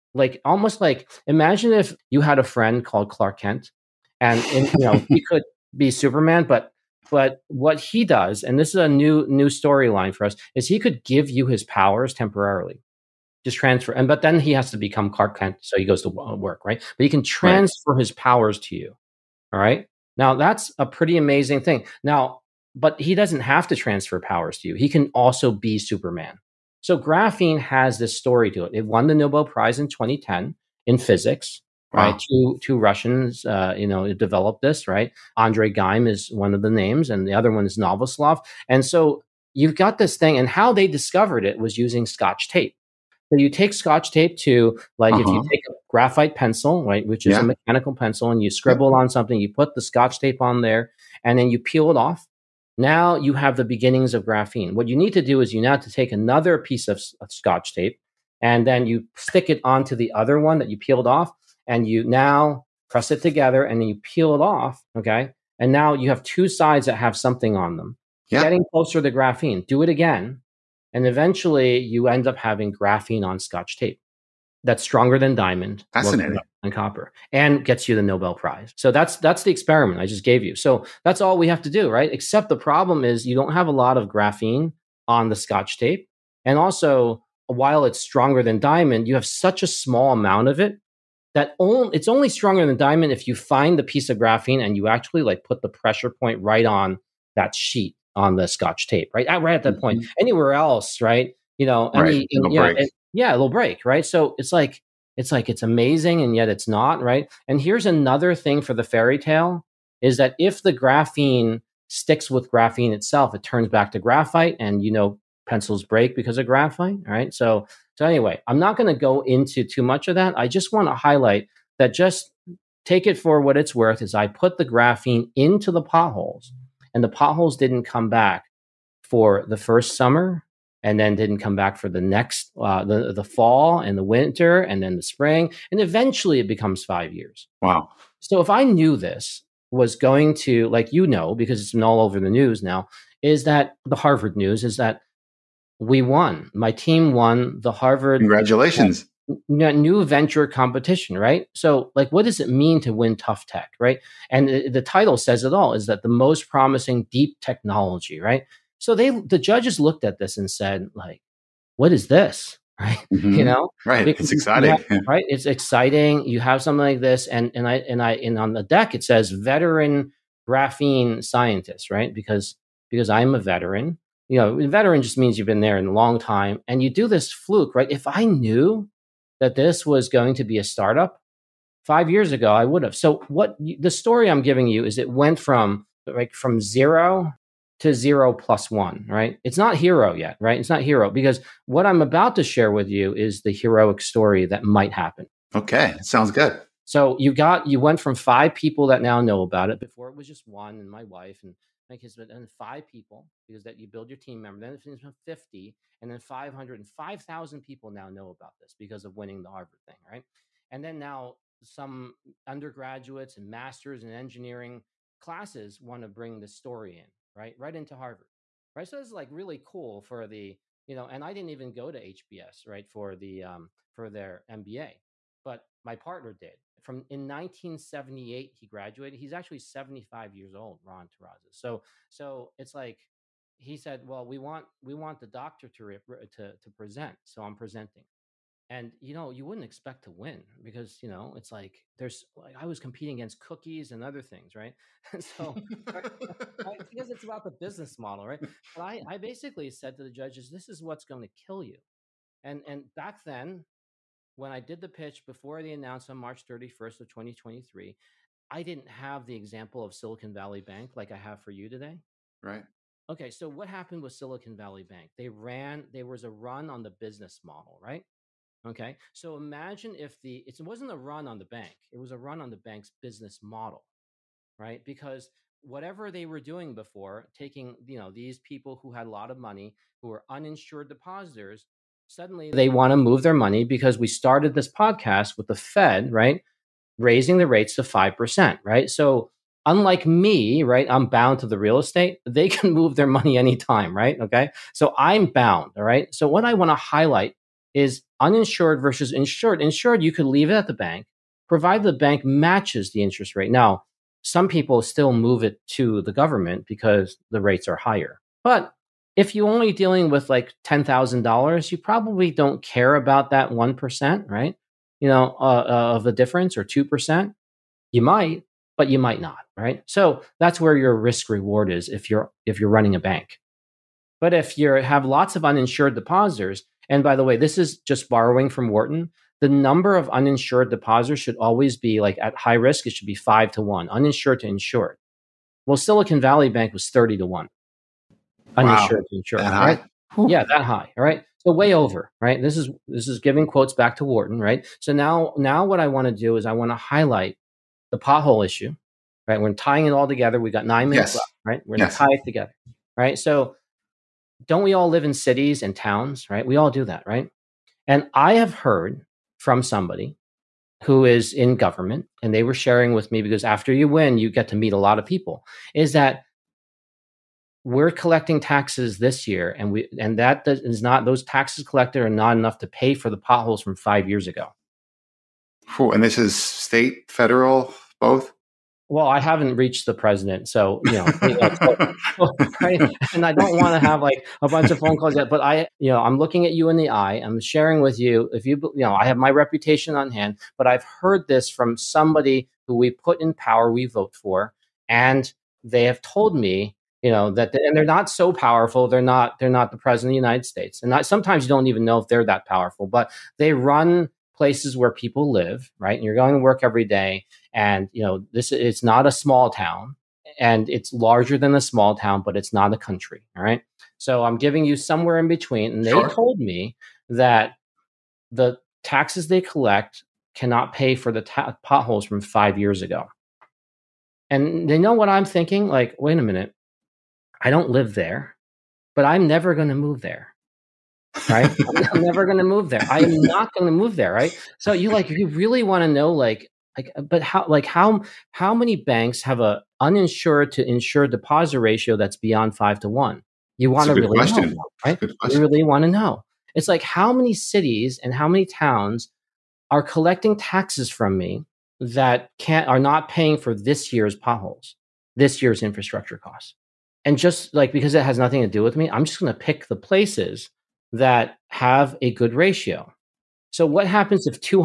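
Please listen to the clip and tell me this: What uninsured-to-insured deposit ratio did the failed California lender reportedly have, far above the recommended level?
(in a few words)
30 to 1.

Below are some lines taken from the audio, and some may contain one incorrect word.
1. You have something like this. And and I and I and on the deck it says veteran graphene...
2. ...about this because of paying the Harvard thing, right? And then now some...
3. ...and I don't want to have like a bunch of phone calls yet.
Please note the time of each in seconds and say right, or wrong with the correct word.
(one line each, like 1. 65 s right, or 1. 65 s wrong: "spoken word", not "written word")
1. 166 s right
2. 208 s wrong: "winning", not "paying"
3. 381 s right.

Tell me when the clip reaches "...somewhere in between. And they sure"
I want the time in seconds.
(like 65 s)
414 s.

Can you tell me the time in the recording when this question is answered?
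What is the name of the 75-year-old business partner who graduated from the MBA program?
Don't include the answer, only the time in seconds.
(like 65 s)
230 s.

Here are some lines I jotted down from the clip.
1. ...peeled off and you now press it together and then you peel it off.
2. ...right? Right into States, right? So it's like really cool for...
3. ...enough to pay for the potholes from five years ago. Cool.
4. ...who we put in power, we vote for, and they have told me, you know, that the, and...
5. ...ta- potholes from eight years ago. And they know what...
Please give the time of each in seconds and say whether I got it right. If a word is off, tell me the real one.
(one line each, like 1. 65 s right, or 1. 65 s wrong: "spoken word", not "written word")
1. 60 s right
2. 217 s wrong: "Harvard", not "States"
3. 372 s right
4. 392 s right
5. 421 s wrong: "five", not "eight".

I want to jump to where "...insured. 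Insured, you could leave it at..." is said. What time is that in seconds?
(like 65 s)
299 s.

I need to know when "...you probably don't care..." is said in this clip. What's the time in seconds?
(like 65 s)
311 s.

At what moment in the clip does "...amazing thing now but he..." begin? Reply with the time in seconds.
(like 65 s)
21 s.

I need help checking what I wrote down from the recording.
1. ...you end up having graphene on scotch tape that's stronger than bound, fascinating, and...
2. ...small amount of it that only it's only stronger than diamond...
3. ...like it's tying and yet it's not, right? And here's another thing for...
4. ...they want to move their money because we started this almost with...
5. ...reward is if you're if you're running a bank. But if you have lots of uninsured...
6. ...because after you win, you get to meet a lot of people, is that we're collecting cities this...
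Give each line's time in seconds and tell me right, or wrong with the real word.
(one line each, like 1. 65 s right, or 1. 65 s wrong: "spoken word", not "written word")
1. 71 s wrong: "diamond", not "bound"
2. 89 s right
3. 105 s wrong: "amazing", not "tying"
4. 282 s wrong: "podcast", not "almost"
5. 321 s right
6. 363 s wrong: "taxes", not "cities".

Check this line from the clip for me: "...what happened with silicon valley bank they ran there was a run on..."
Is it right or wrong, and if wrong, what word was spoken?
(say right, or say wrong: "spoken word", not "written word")
right.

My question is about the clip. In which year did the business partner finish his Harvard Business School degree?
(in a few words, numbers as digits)
1978.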